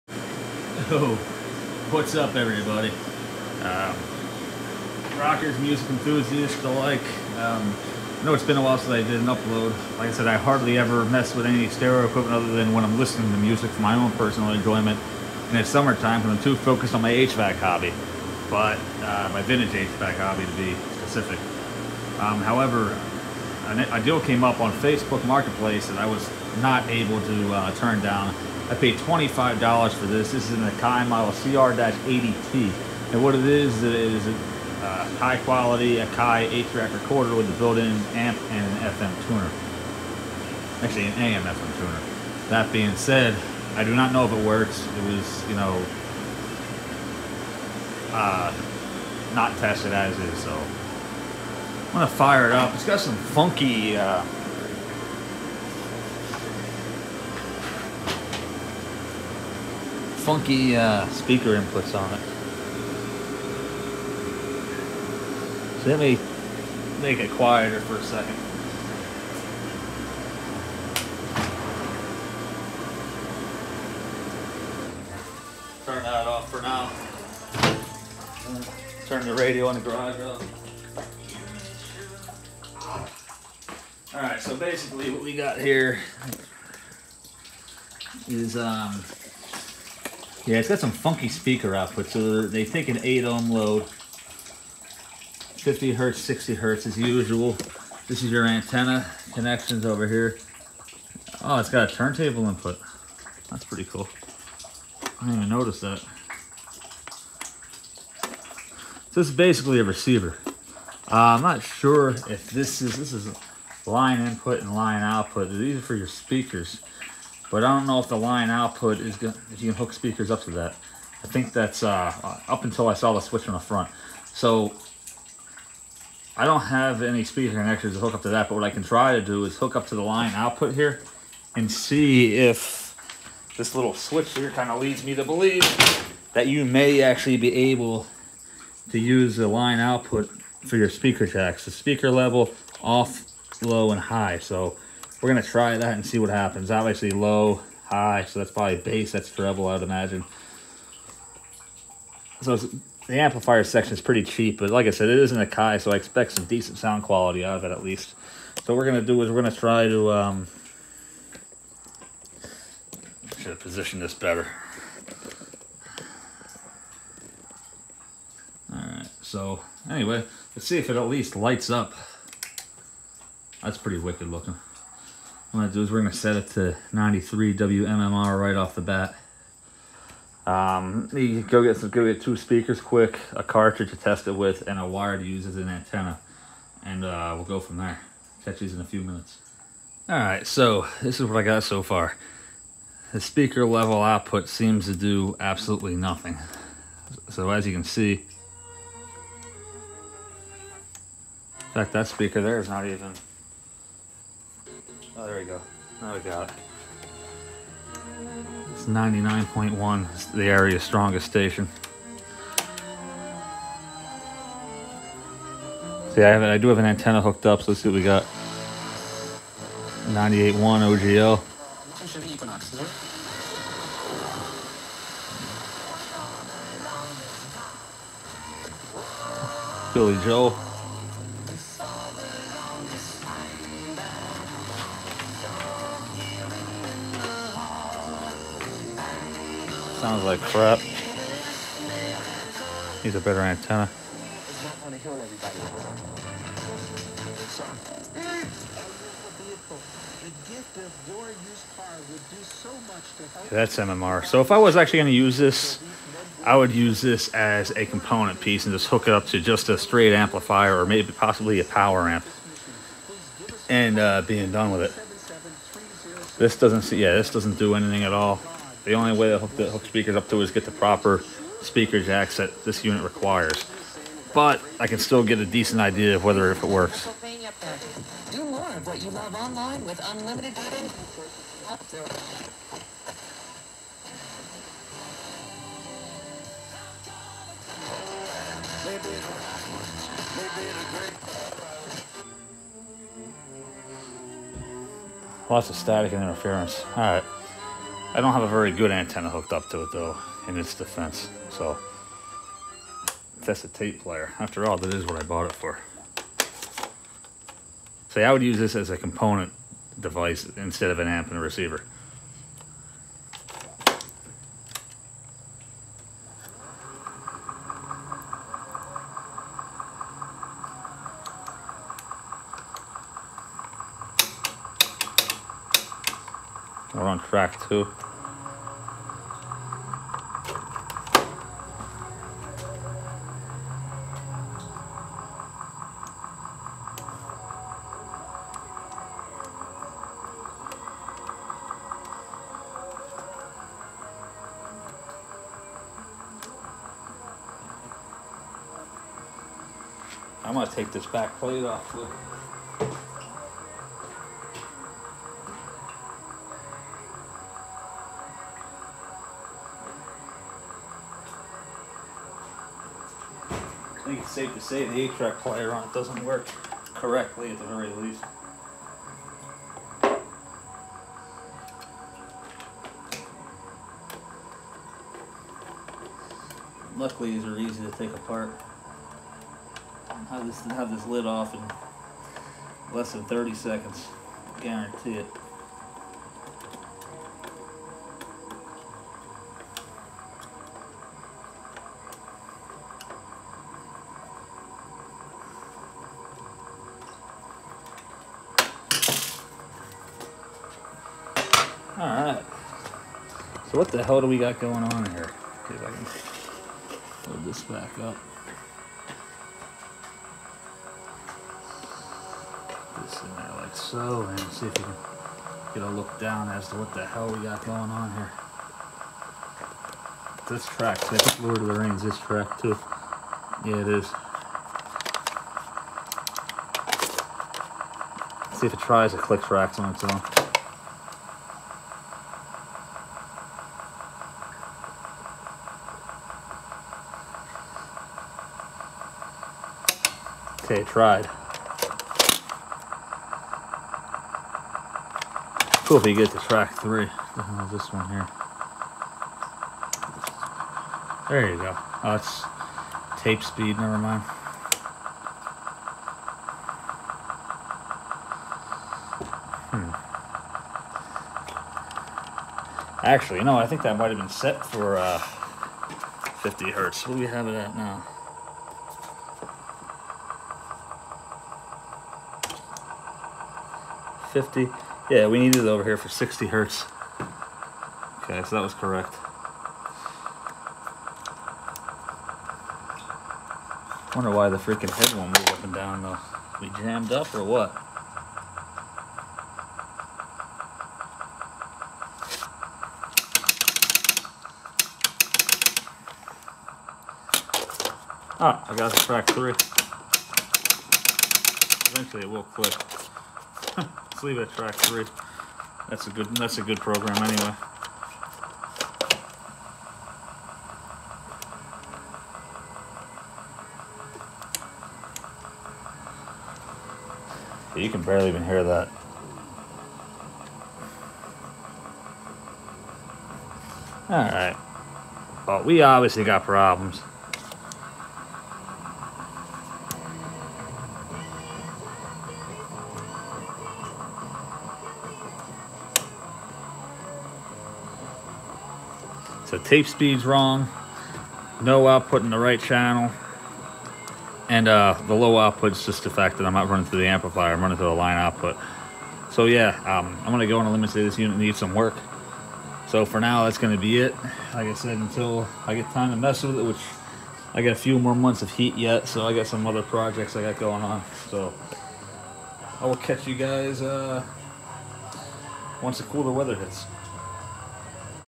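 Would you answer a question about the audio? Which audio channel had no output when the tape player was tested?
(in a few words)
right channel.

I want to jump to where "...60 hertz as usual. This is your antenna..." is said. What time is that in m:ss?
1:36.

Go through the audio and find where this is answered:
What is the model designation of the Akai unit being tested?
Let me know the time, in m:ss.
0:31.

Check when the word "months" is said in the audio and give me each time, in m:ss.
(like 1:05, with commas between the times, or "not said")
9:18.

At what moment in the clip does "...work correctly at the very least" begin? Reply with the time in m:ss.
6:06.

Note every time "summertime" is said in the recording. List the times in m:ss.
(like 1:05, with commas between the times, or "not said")
0:15.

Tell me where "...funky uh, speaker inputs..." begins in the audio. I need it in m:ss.
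1:00.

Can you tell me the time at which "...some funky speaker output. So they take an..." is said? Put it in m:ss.
1:30.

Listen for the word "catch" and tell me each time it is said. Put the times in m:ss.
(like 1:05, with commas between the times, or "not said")
3:08, 9:22.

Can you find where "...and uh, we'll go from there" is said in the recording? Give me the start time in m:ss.
3:06.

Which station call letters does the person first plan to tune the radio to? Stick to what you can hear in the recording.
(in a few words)
WMMR.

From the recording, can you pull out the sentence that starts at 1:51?
Uh, I'm not sure if this is, this is line input and line output.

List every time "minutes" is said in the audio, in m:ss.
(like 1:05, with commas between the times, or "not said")
3:09.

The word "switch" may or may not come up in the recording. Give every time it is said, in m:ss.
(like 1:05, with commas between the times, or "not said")
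2:03, 2:13.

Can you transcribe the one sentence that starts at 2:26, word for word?
Obviously low, high, so that's probably bass.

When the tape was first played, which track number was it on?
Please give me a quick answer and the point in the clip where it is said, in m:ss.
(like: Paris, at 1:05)
track two, at 5:27.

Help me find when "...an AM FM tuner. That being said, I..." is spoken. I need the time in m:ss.
0:41.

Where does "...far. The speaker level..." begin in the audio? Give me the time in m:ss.
3:11.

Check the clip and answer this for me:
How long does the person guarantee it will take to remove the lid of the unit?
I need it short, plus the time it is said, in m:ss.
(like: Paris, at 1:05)
30 seconds, at 6:23.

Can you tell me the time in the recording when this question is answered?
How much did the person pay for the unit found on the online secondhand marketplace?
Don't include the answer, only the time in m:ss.
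0:28.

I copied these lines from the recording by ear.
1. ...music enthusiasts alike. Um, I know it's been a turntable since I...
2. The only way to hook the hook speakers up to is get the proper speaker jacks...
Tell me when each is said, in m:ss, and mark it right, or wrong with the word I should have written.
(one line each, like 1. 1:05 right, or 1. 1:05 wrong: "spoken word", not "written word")
1. 0:05 wrong: "while", not "turntable"
2. 4:28 right.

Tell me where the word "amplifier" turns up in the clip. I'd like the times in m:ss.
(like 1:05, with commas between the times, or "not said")
2:33, 4:20, 9:07.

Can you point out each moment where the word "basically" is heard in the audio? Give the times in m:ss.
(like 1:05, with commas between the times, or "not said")
1:24, 1:49.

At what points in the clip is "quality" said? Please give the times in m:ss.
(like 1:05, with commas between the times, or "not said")
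0:35, 2:37.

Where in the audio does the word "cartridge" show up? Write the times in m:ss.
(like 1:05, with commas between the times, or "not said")
3:03.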